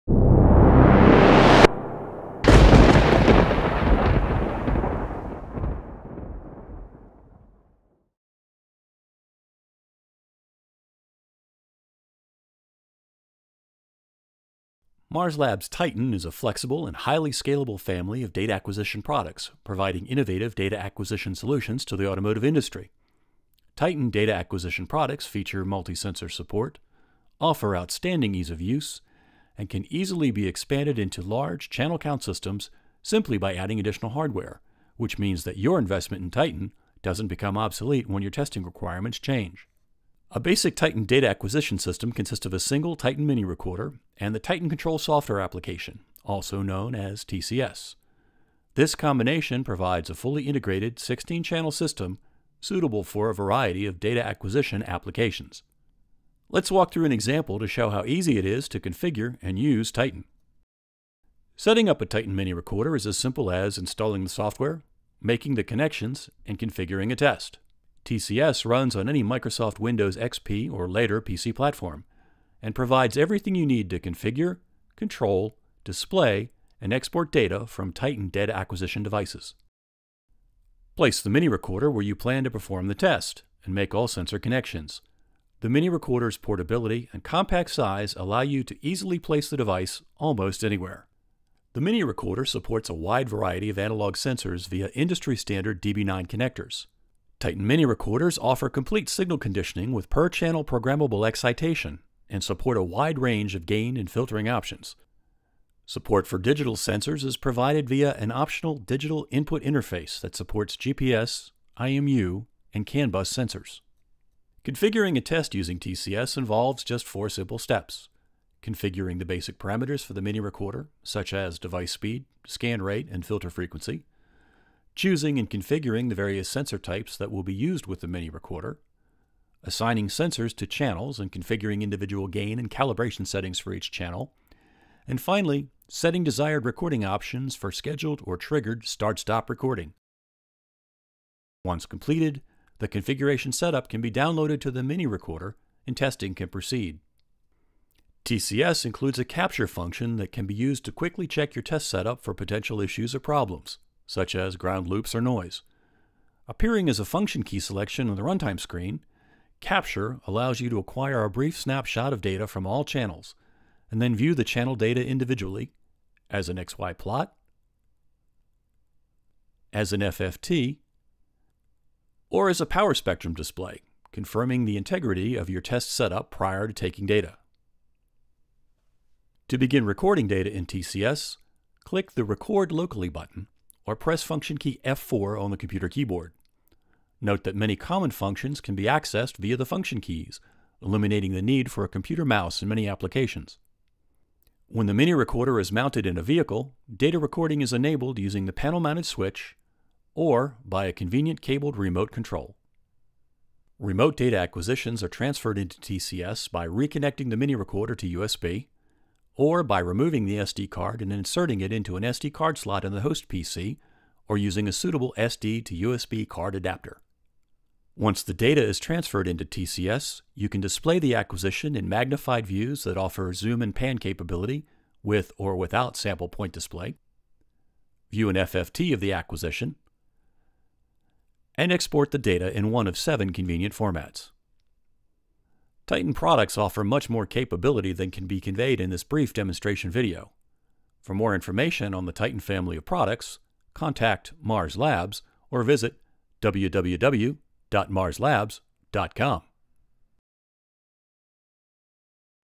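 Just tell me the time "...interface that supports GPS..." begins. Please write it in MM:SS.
01:49.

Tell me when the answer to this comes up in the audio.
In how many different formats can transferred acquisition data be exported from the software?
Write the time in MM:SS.
03:52.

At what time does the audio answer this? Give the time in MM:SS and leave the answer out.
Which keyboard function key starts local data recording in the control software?
03:04.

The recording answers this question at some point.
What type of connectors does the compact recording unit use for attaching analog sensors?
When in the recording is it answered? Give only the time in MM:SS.
01:35.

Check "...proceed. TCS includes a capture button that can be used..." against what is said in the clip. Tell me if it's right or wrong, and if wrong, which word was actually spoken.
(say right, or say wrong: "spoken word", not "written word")
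wrong: "function", not "button".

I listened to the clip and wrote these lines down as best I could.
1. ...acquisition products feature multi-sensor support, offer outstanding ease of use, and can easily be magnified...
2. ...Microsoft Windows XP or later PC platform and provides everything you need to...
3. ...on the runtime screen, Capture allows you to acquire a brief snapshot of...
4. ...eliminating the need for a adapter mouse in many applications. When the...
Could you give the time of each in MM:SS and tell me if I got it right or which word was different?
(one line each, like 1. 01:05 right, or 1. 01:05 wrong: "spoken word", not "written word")
1. 00:24 wrong: "expanded", not "magnified"
2. 01:09 right
3. 02:38 right
4. 03:10 wrong: "computer", not "adapter".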